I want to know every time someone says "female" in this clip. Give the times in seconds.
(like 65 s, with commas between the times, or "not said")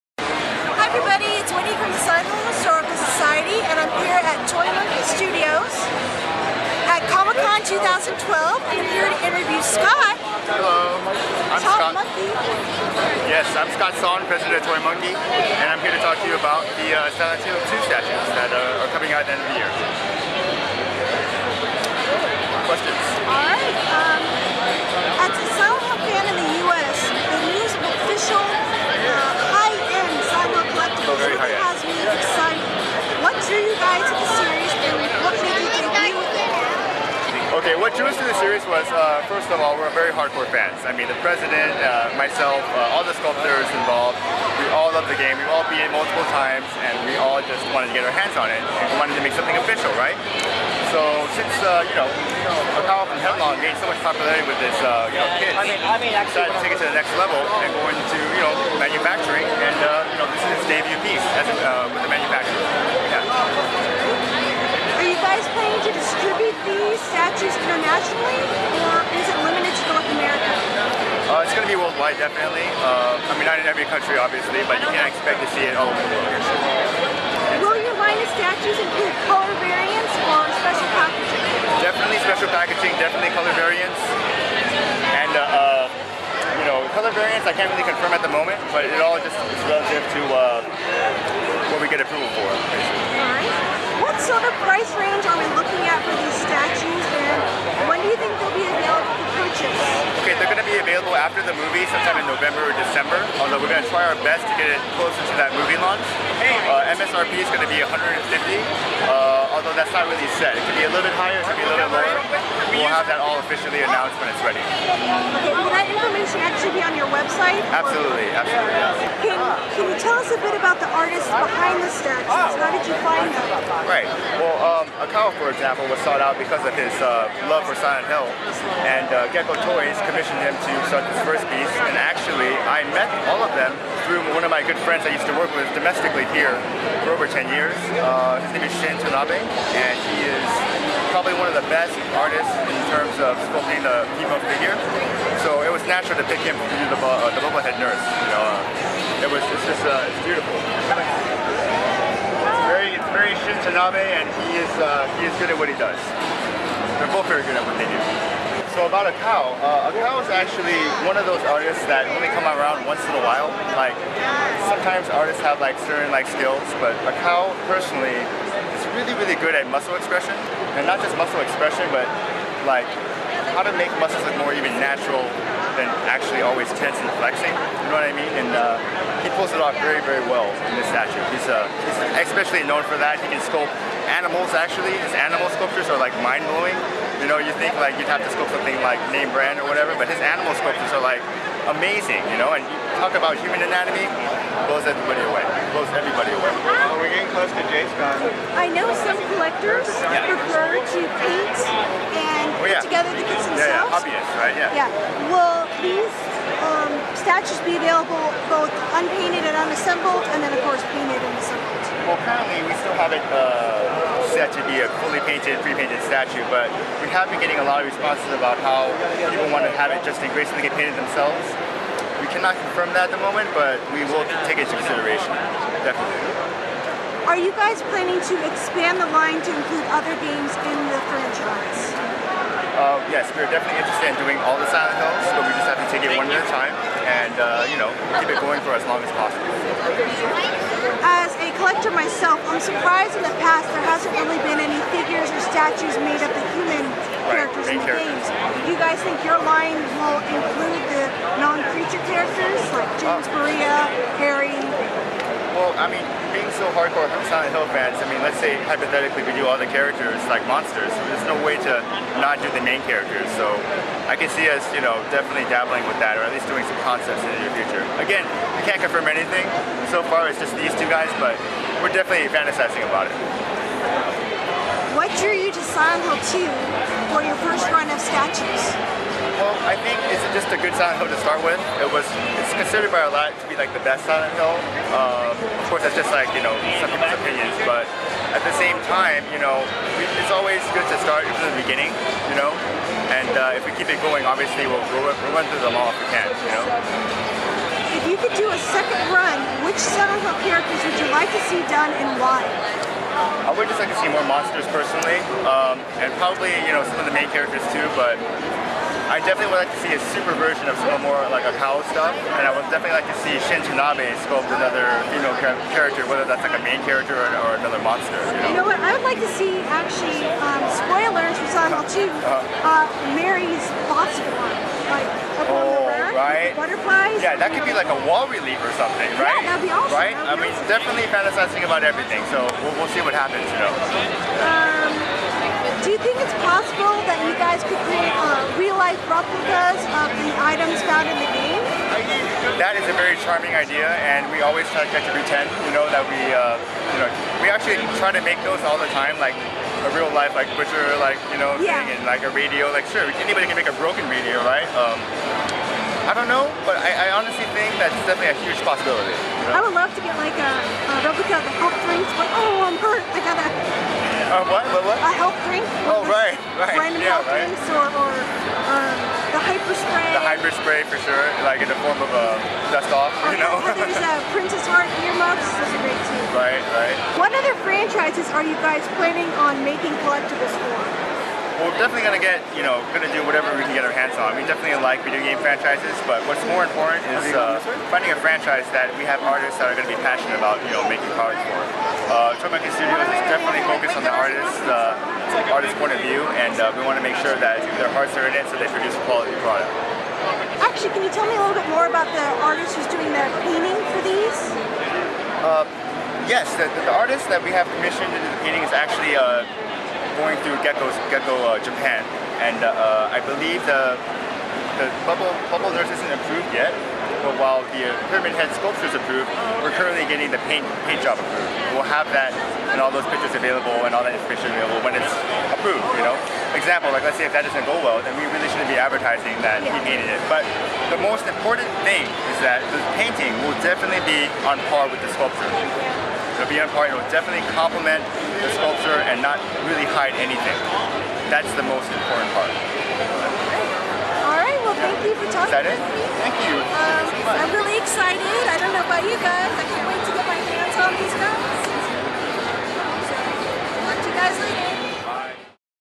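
144 s, 315 s.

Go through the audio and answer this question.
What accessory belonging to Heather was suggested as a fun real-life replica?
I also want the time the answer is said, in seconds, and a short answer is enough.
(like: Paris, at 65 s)
Earmuffs, at 375 s.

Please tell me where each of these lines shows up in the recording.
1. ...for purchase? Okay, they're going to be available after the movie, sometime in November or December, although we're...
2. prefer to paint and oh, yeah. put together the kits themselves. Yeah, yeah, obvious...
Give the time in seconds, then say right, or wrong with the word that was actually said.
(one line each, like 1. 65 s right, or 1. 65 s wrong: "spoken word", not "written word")
1. 99 s right
2. 200 s right.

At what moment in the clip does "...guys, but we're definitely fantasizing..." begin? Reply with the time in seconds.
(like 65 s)
270 s.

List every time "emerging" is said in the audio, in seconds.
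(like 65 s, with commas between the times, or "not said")
not said.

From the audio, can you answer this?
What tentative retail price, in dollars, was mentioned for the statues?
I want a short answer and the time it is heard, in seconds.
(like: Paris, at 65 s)
150, at 107 s.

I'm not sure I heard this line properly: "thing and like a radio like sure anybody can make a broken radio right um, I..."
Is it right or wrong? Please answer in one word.
right.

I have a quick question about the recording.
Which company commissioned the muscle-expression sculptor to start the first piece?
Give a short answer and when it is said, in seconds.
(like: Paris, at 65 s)
Gecco Toys, at 129 s.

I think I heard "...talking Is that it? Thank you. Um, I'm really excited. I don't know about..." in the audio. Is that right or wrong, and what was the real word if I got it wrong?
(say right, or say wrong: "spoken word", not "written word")
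right.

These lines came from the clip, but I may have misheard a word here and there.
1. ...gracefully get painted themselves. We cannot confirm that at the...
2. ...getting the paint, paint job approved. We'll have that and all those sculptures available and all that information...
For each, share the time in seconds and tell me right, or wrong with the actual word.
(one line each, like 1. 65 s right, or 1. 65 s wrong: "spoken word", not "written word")
1. 220 s right
2. 420 s wrong: "pictures", not "sculptures".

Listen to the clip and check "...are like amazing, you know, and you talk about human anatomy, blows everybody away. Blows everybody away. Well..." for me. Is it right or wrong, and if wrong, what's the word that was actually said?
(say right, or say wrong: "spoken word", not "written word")
right.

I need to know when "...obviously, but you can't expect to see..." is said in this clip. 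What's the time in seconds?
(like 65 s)
74 s.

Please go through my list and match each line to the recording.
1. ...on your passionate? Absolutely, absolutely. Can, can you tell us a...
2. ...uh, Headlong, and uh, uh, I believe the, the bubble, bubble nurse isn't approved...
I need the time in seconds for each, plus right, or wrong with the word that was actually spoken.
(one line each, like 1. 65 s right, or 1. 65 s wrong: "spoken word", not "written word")
1. 116 s wrong: "website", not "passionate"
2. 411 s wrong: "Japan", not "Headlong".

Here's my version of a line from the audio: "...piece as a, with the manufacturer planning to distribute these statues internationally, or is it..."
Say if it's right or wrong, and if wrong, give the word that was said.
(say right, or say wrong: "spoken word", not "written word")
right.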